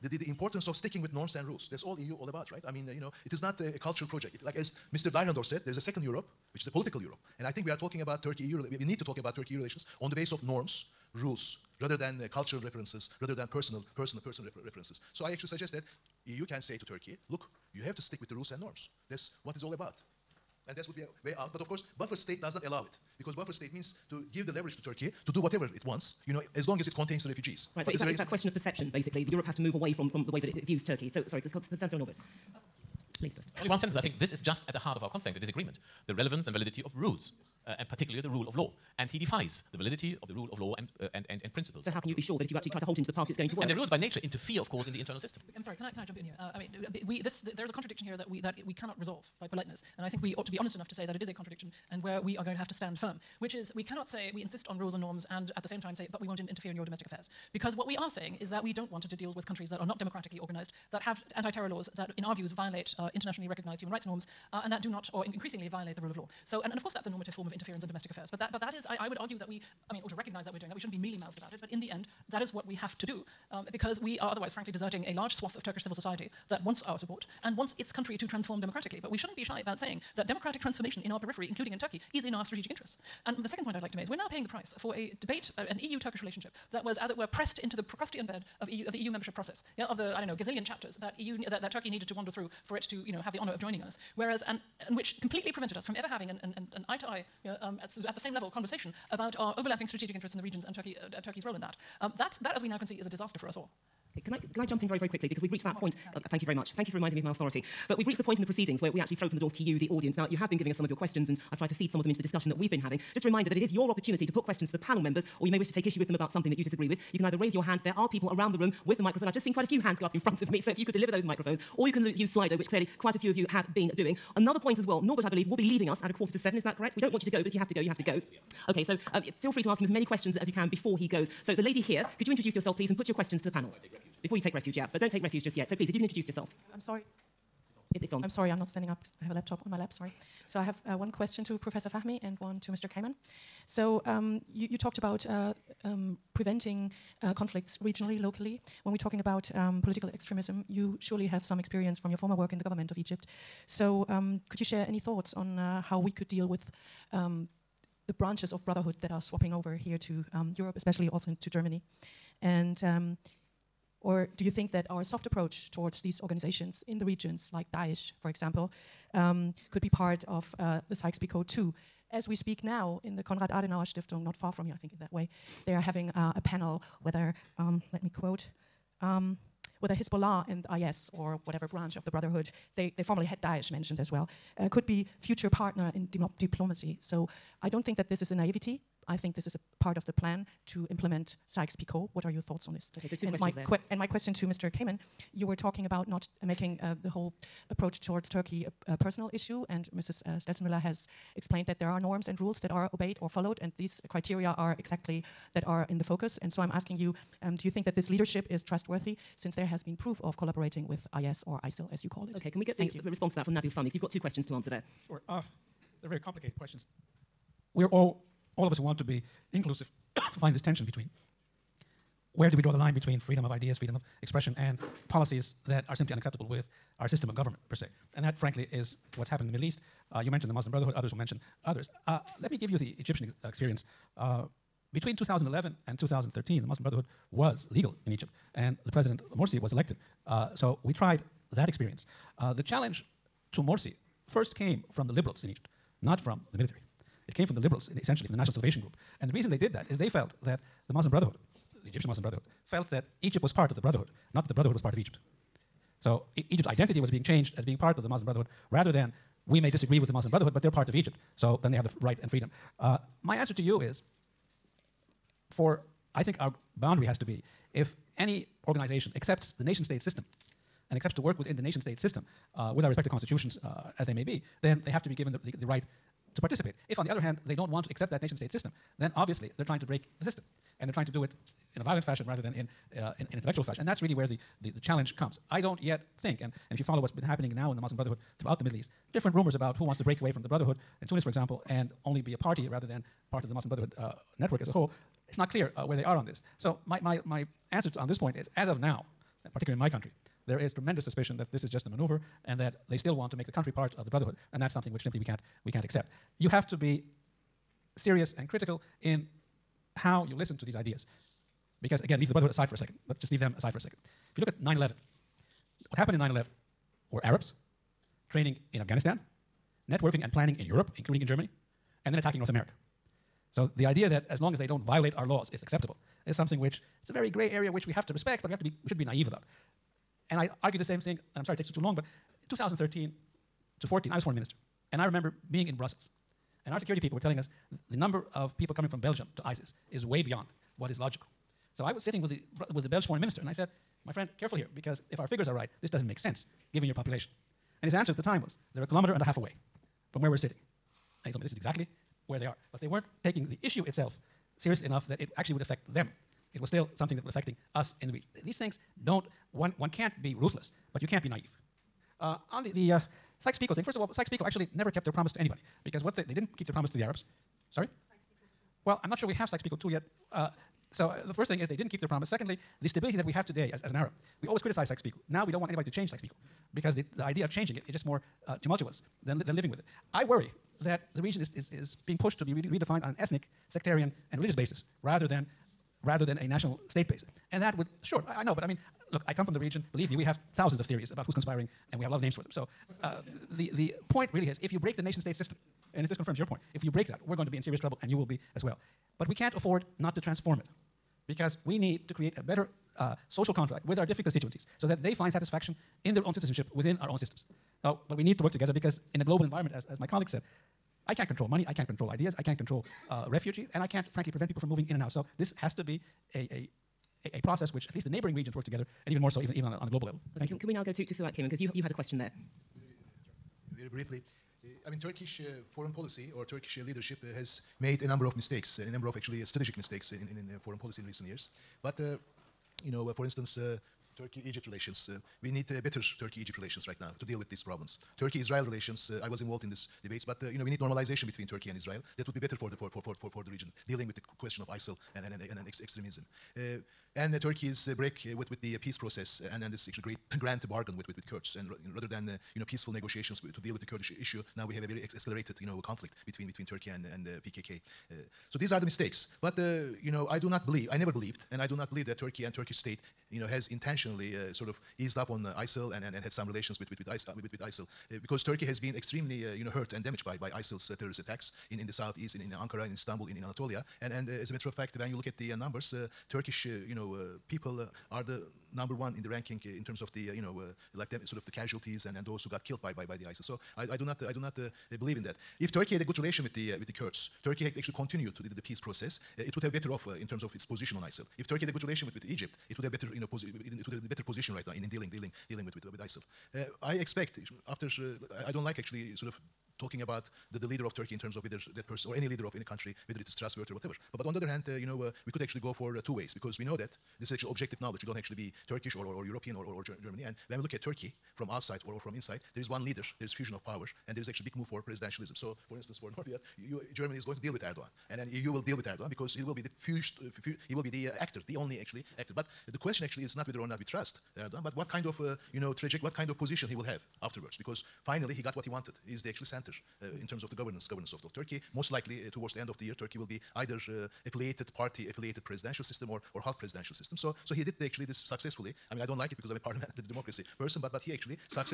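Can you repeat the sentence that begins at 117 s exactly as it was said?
You can either raise your hand.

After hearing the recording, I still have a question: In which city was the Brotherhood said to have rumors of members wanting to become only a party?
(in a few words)
Tunis.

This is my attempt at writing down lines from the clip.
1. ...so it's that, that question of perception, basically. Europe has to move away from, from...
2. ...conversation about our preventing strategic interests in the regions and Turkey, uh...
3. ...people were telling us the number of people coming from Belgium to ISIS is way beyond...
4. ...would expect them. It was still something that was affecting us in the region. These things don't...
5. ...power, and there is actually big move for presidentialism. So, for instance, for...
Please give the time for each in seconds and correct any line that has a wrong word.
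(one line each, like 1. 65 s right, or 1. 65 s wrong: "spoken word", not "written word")
1. 27 s right
2. 98 s wrong: "overlapping", not "preventing"
3. 336 s right
4. 355 s wrong: "affect", not "expect"
5. 513 s right.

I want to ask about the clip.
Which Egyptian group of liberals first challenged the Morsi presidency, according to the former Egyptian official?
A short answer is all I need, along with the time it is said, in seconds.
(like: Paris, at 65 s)
National Salvation Group, at 248 s.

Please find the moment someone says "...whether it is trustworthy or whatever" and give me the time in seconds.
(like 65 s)
503 s.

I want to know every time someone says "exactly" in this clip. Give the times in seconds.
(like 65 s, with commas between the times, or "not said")
204 s, 351 s.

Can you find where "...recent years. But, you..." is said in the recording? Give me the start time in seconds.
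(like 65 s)
431 s.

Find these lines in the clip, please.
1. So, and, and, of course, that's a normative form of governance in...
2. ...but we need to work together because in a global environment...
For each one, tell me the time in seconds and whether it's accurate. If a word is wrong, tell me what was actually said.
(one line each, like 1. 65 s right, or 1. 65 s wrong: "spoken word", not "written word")
1. 66 s wrong: "interference", not "governance"
2. 408 s right.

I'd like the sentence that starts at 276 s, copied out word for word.
If, on the other hand, they don't want to accept that nation state system, then obviously they're trying to break the system.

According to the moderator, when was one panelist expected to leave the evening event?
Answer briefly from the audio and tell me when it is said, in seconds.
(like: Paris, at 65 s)
a quarter to seven, at 126 s.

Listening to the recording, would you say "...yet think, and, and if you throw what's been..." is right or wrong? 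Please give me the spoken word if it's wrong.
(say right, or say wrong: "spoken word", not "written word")
wrong: "follow", not "throw".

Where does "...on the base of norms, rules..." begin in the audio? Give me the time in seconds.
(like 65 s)
9 s.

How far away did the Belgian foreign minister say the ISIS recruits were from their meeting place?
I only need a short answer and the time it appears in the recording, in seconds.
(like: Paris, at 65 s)
a kilometer and a half, at 348 s.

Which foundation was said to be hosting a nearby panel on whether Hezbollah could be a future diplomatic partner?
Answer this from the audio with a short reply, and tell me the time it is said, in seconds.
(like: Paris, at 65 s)
Konrad Adenauer Stiftung, at 173 s.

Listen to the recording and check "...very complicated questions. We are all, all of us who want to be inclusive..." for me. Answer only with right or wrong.
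right.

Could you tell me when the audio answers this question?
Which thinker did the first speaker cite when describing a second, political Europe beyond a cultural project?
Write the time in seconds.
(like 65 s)
5 s.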